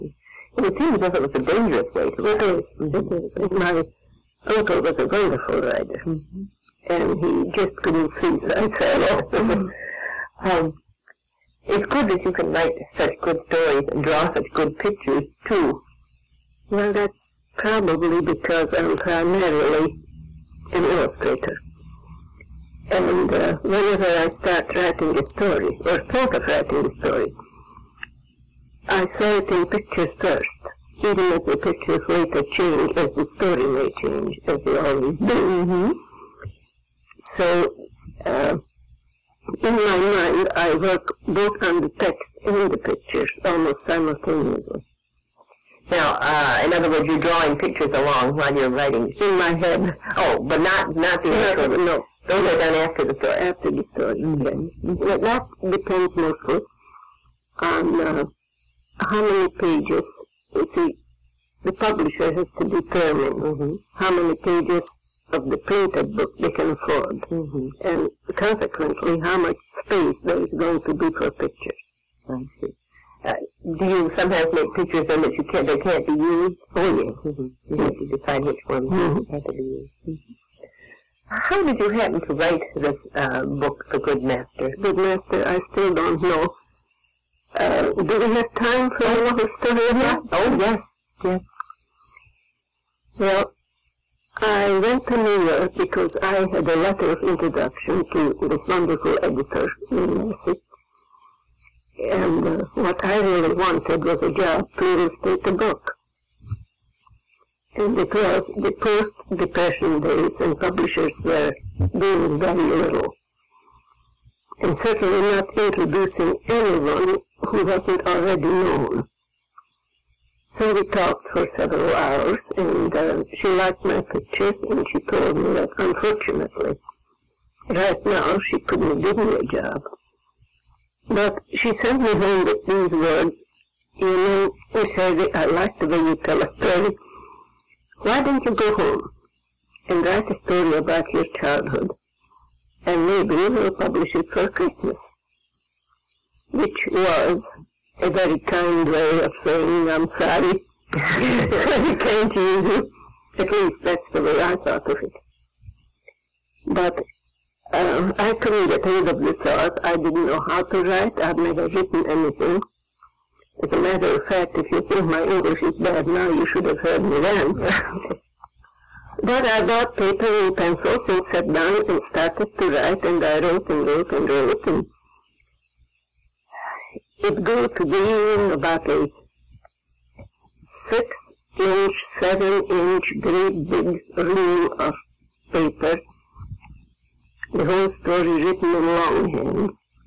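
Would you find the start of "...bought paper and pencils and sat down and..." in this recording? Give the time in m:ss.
2:49.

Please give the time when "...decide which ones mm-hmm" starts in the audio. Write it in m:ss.
1:18.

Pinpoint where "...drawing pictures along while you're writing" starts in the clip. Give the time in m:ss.
0:47.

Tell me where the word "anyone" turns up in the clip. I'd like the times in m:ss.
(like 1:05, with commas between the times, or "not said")
1:56.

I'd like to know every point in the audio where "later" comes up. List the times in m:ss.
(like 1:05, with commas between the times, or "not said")
0:32.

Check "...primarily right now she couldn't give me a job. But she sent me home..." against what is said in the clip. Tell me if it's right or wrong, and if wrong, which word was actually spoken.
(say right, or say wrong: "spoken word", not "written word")
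wrong: "unfortunately", not "primarily".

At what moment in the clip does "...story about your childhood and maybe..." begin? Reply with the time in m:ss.
2:20.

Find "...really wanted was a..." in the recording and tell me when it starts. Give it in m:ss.
1:43.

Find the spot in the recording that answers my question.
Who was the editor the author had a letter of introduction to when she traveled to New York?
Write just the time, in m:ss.
1:39.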